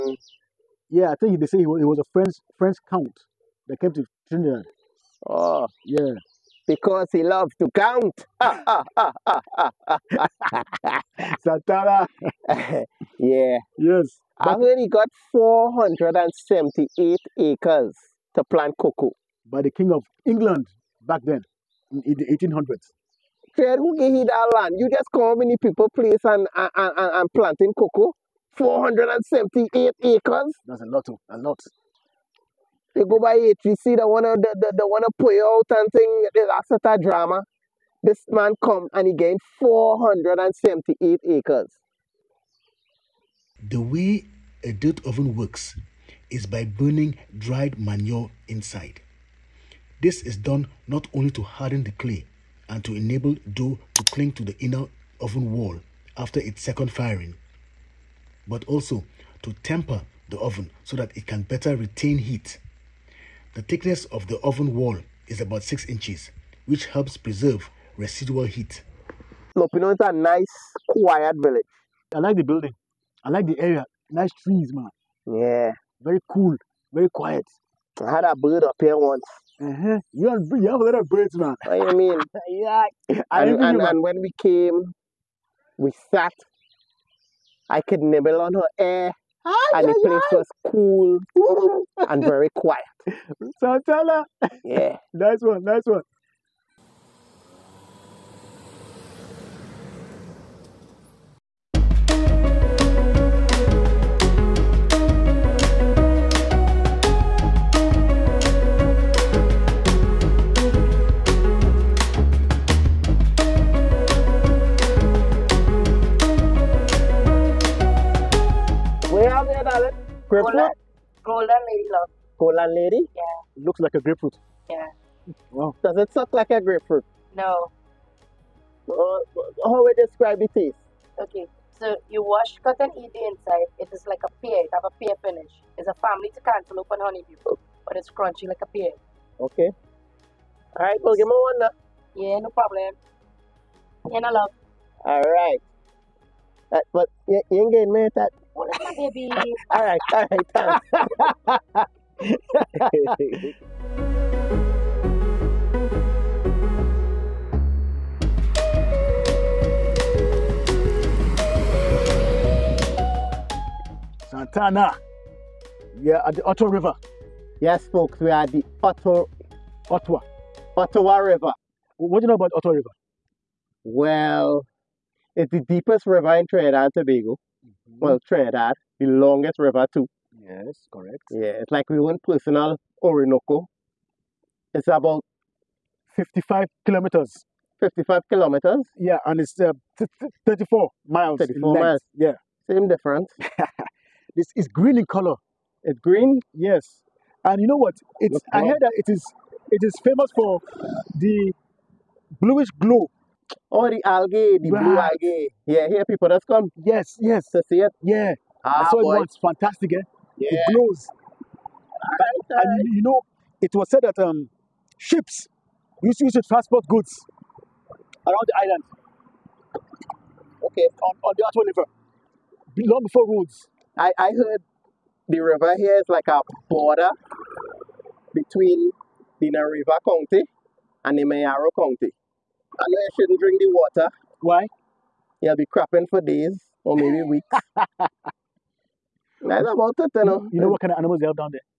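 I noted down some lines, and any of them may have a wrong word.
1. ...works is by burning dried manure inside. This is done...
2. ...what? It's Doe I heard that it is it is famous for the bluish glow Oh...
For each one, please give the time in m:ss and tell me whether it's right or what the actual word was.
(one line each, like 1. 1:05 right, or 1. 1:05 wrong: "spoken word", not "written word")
1. 0:45 right
2. 3:17 wrong: "Look", not "Doe".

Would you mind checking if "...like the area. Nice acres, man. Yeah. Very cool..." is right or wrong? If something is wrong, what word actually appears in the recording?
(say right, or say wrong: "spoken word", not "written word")
wrong: "trees", not "acres".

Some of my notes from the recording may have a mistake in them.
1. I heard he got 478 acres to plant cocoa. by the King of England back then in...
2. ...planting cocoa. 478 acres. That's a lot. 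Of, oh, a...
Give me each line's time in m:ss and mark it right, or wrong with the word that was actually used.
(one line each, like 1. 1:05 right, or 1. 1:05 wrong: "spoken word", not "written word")
1. 0:14 right
2. 0:27 right.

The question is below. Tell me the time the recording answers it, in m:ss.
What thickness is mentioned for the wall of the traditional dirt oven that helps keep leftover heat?
1:05.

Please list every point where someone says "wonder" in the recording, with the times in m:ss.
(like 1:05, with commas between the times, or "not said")
not said.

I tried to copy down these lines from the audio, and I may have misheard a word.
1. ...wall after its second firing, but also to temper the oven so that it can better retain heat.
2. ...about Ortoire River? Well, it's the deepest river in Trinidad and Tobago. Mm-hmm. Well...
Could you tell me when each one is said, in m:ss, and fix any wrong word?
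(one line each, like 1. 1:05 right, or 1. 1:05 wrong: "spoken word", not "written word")
1. 0:55 right
2. 2:52 right.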